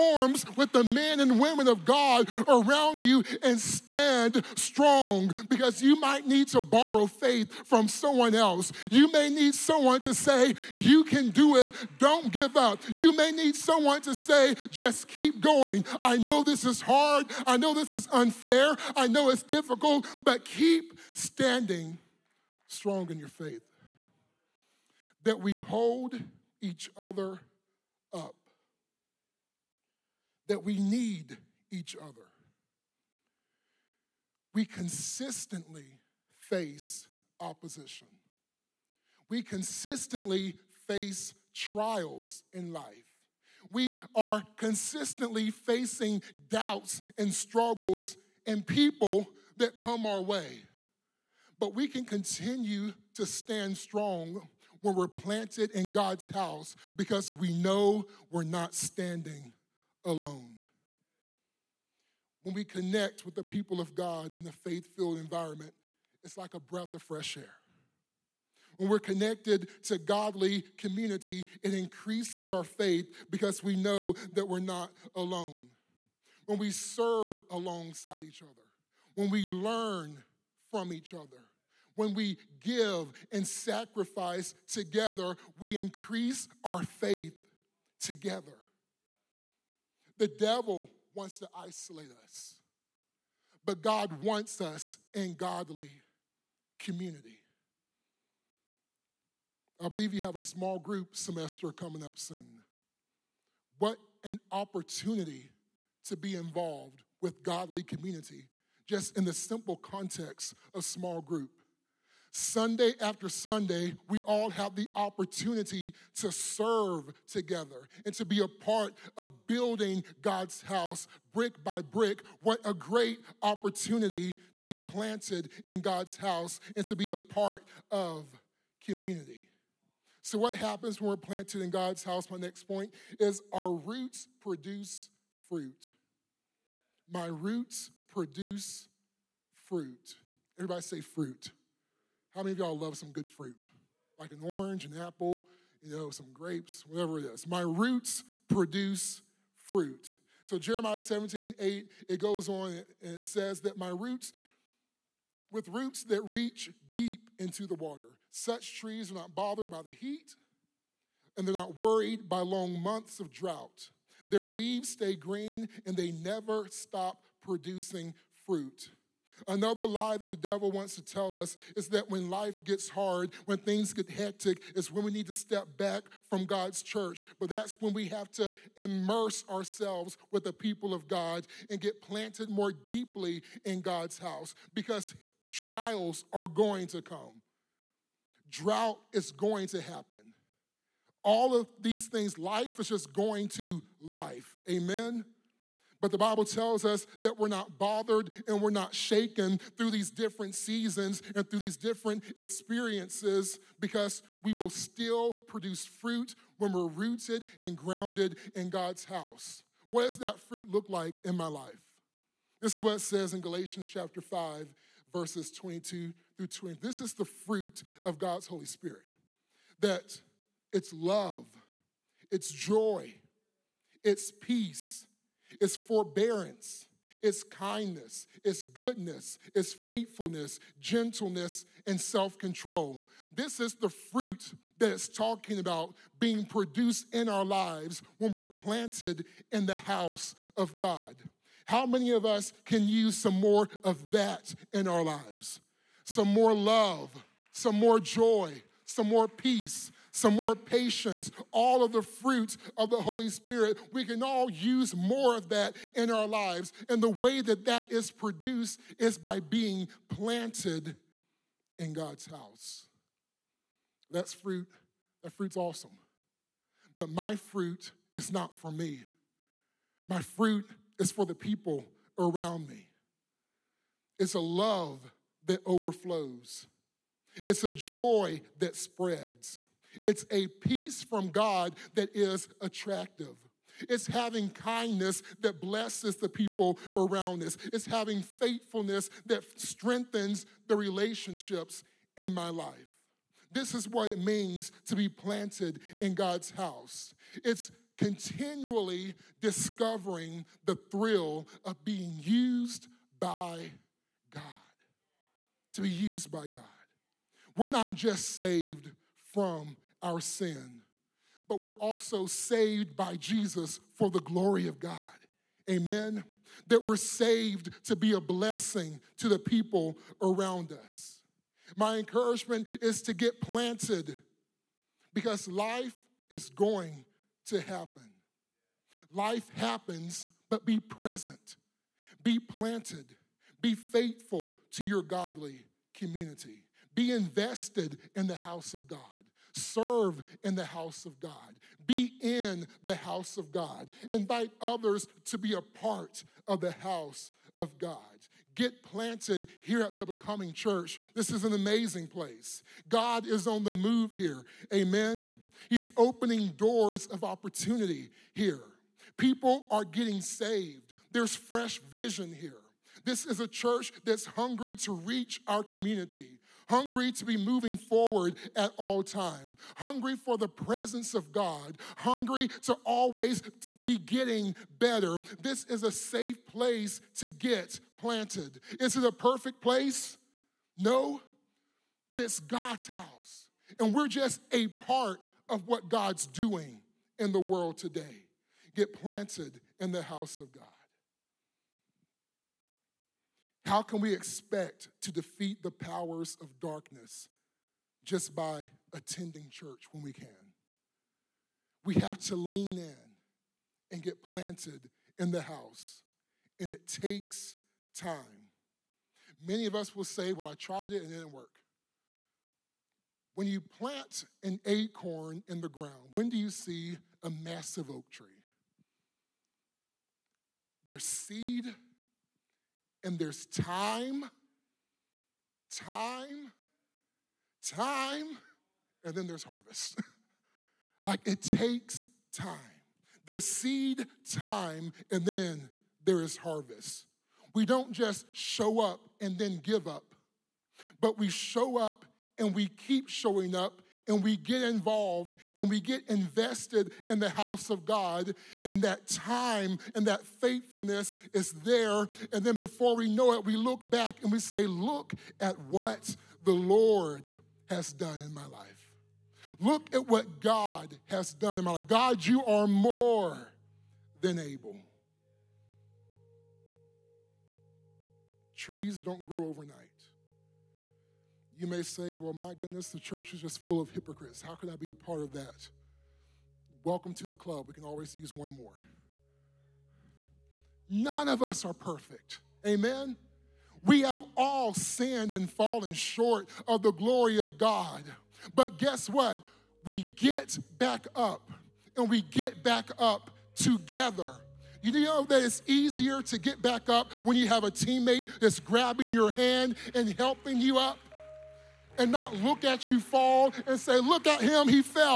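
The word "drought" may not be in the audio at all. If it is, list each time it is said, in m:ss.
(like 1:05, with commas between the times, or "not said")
2:43, 3:08.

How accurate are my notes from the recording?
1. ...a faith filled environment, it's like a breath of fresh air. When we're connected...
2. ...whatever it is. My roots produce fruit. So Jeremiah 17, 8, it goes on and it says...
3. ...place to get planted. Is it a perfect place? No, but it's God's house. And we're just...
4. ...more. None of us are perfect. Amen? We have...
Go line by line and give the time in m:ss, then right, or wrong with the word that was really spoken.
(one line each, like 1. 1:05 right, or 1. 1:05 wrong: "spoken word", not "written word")
1. 1:04 right
2. 2:26 right
3. 6:16 right
4. 7:58 right.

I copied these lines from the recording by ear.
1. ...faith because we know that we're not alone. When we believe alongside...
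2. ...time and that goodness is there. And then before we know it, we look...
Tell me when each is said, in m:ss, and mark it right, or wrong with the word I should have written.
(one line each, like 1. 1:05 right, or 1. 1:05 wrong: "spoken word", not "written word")
1. 1:12 wrong: "serve", not "believe"
2. 7:29 wrong: "faithfulness", not "goodness".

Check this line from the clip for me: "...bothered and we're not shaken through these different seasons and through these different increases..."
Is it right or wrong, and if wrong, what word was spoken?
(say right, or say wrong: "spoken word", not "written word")
wrong: "experiences", not "increases".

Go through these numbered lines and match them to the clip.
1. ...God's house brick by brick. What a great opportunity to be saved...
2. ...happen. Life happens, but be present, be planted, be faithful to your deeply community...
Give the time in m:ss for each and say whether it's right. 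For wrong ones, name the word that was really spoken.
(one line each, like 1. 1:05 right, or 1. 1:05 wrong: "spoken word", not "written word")
1. 2:00 wrong: "planted", not "saved"
2. 5:27 wrong: "godly", not "deeply".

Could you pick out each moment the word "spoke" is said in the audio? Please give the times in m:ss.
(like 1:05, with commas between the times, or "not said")
not said.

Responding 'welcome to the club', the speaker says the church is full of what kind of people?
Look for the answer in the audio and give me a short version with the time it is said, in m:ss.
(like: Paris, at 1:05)
hypocrites, at 7:53.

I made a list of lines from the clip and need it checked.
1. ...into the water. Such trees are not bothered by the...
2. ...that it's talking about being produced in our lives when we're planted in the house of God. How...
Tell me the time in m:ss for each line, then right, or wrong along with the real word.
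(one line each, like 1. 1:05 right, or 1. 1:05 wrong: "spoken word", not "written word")
1. 2:37 right
2. 3:54 right.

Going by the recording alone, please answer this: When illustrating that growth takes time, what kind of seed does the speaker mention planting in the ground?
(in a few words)
acorn.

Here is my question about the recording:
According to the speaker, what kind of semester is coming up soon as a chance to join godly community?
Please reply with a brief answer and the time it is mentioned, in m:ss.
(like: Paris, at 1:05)
small group semester, at 1:40.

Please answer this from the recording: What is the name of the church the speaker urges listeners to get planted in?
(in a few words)
the Becoming Church.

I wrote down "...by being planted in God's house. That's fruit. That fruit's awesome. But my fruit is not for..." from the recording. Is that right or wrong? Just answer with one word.
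right.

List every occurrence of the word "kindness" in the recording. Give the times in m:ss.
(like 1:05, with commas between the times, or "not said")
3:47, 4:44.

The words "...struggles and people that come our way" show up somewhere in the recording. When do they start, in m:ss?
0:47.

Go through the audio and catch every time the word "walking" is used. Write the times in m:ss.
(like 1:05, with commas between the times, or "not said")
not said.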